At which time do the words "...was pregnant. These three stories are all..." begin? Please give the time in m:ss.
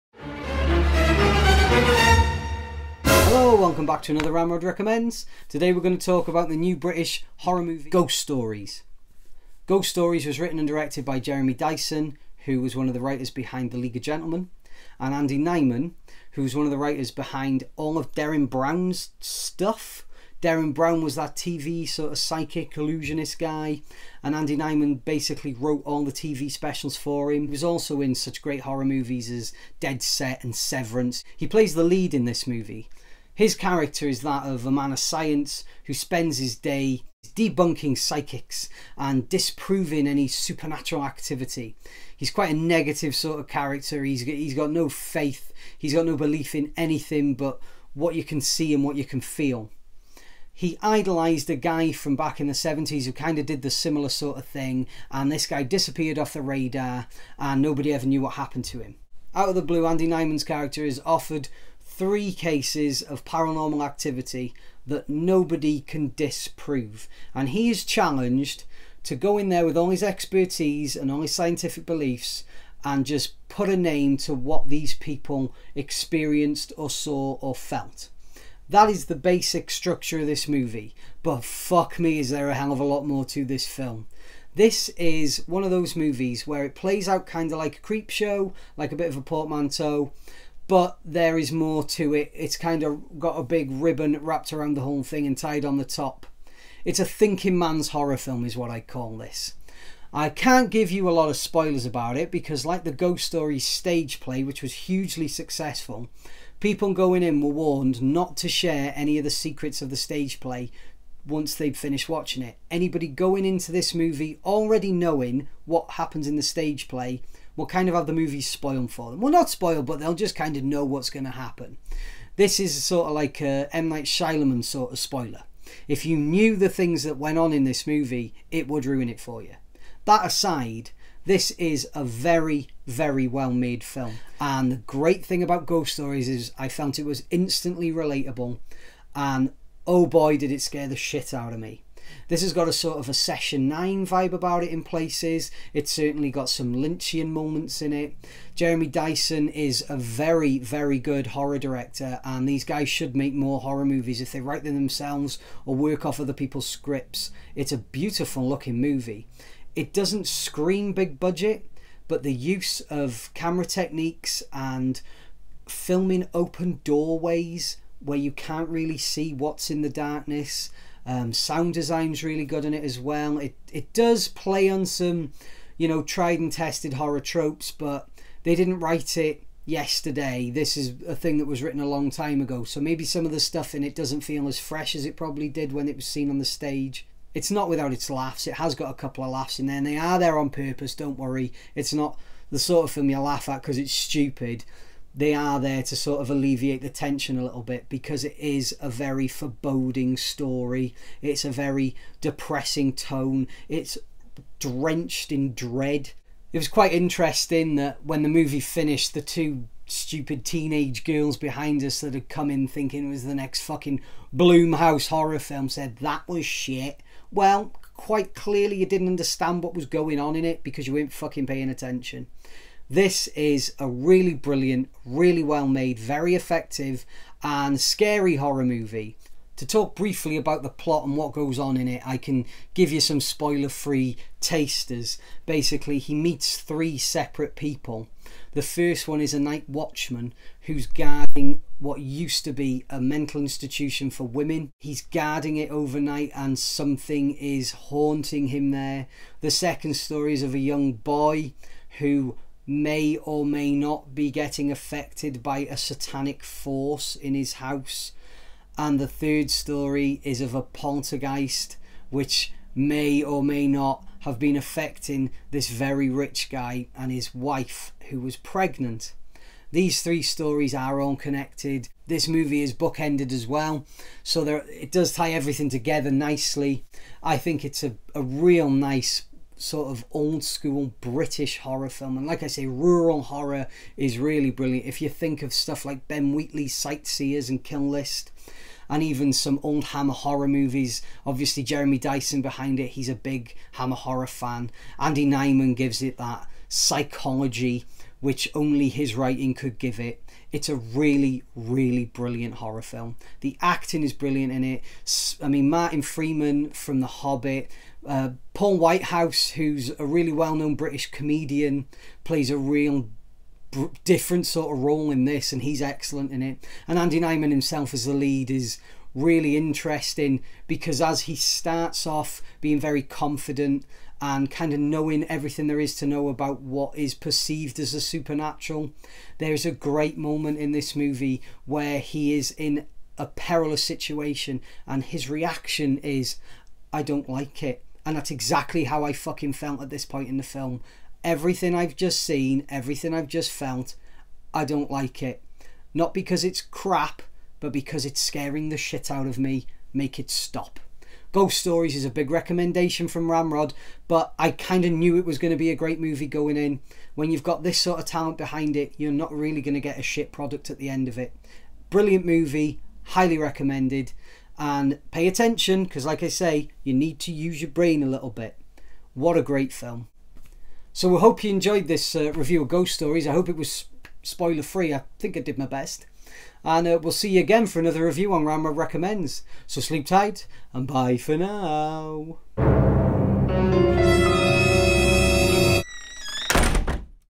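4:28.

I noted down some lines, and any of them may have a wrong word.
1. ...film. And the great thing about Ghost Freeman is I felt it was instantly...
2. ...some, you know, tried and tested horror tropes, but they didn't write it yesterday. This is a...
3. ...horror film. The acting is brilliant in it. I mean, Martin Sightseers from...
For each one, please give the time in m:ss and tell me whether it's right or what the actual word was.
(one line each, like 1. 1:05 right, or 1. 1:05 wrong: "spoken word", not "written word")
1. 2:13 wrong: "Stories", not "Freeman"
2. 2:54 right
3. 5:02 wrong: "Freeman", not "Sightseers".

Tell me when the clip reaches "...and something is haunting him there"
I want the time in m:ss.
4:06.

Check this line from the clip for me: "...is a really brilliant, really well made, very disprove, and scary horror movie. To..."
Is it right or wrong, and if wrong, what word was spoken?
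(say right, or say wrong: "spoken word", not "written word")
wrong: "effective", not "disprove".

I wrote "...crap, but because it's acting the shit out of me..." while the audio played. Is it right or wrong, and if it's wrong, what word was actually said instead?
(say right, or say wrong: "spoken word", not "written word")
wrong: "scaring", not "acting".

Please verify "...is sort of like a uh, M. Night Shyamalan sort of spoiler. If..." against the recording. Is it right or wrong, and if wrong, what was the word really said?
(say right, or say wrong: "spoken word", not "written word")
right.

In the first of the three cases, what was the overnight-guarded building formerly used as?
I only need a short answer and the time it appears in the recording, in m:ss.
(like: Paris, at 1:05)
a mental institution for women, at 4:02.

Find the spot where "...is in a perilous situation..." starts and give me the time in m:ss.
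5:32.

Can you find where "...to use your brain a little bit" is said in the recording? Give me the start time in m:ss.
6:07.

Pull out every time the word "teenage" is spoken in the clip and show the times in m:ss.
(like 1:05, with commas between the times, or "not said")
3:30.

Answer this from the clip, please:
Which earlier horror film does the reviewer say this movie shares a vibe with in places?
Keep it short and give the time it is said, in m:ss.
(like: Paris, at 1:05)
Session 9, at 2:23.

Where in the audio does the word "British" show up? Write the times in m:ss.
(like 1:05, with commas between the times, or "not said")
0:06, 4:41, 5:10.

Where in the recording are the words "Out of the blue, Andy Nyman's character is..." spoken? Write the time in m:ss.
0:59.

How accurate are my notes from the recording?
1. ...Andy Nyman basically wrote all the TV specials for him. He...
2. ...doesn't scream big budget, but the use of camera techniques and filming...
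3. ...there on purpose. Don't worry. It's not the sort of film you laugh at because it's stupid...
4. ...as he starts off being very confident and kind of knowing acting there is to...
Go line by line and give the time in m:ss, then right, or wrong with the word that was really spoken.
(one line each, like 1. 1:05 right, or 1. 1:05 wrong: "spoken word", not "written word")
1. 0:24 right
2. 2:39 right
3. 3:10 right
4. 5:21 wrong: "everything", not "acting".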